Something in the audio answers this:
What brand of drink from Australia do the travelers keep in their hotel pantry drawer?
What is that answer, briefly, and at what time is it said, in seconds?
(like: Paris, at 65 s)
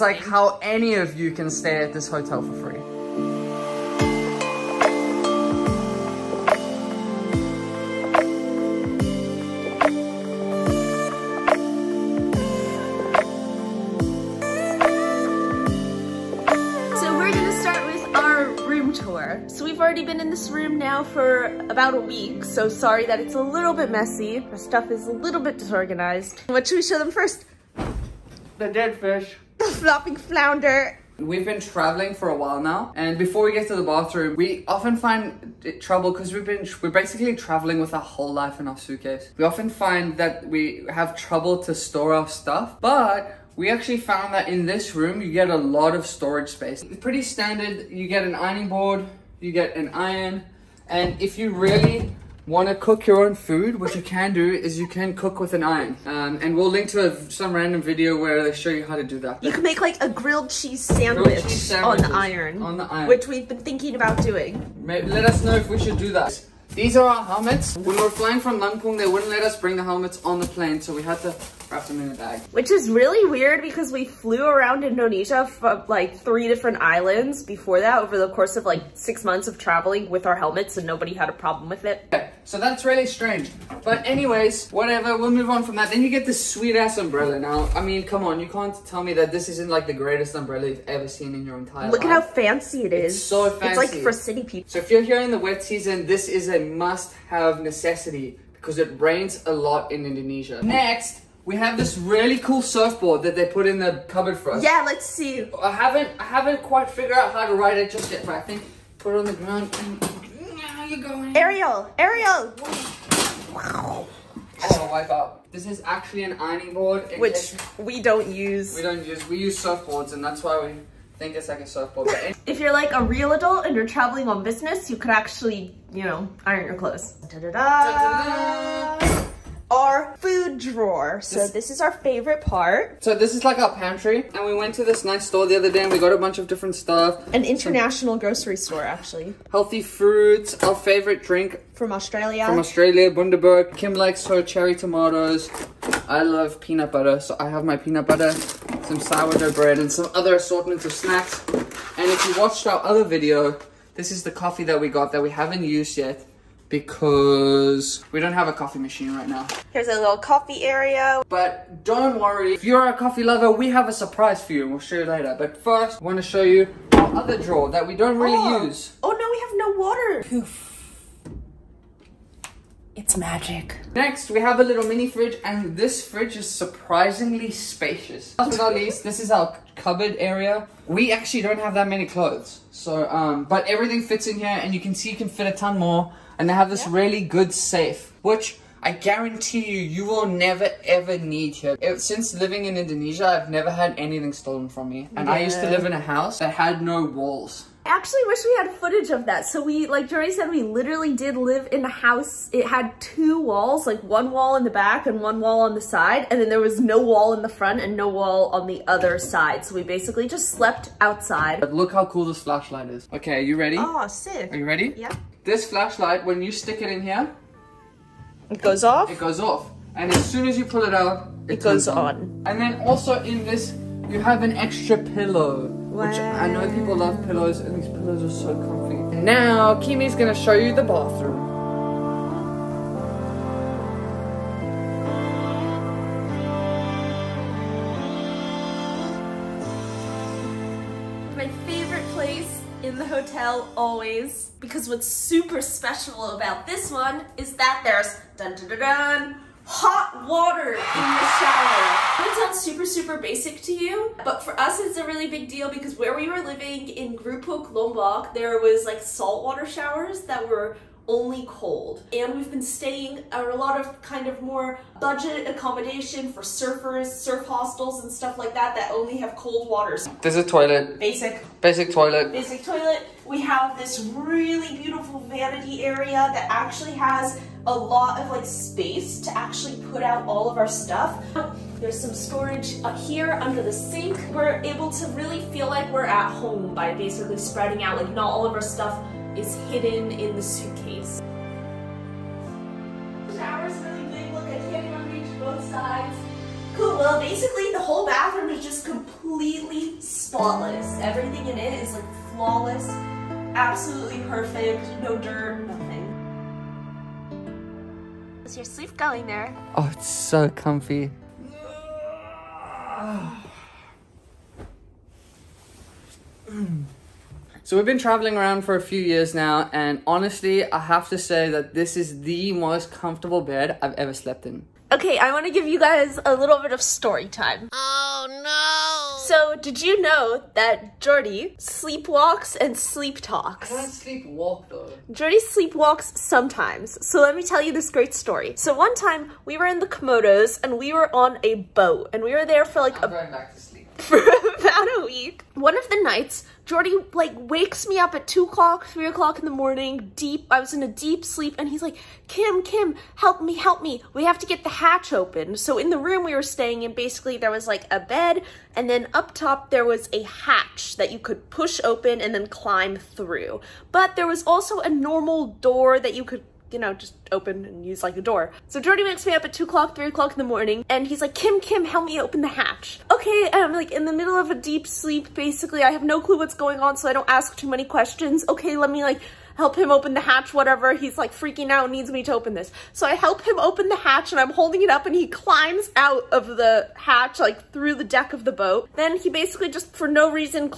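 Bundaberg, at 143 s.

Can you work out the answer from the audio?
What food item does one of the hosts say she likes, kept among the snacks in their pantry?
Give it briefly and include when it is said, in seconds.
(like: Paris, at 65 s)
Cherry tomatoes, at 144 s.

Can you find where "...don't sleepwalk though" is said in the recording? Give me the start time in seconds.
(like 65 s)
333 s.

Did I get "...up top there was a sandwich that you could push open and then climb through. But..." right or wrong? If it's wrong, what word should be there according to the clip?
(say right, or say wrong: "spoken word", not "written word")
wrong: "hatch", not "sandwich".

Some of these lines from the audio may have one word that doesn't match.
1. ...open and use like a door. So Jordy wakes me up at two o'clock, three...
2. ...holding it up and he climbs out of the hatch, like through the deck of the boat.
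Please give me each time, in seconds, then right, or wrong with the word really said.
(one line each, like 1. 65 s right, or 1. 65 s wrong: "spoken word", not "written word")
1. 367 s right
2. 384 s right.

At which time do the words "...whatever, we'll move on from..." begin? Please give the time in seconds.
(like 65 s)
84 s.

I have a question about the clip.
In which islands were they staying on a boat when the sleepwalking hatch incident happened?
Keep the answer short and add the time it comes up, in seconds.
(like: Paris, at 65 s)
The Komodos, at 339 s.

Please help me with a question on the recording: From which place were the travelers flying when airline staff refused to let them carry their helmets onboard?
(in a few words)
Lampung.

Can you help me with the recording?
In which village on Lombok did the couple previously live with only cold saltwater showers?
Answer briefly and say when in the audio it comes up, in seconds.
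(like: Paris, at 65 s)
Grupuk, at 257 s.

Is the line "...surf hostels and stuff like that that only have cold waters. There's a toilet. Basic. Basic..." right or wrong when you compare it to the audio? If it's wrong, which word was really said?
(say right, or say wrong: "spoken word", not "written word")
right.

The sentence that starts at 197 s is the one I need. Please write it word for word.
I actually wish we had footage of that.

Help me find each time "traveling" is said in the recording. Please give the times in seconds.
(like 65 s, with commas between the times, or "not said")
31 s, 37 s, 79 s, 123 s, 317 s.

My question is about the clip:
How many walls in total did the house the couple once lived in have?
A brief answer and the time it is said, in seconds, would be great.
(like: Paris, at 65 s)
2, at 203 s.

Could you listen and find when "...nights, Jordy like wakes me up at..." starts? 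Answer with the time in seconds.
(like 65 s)
346 s.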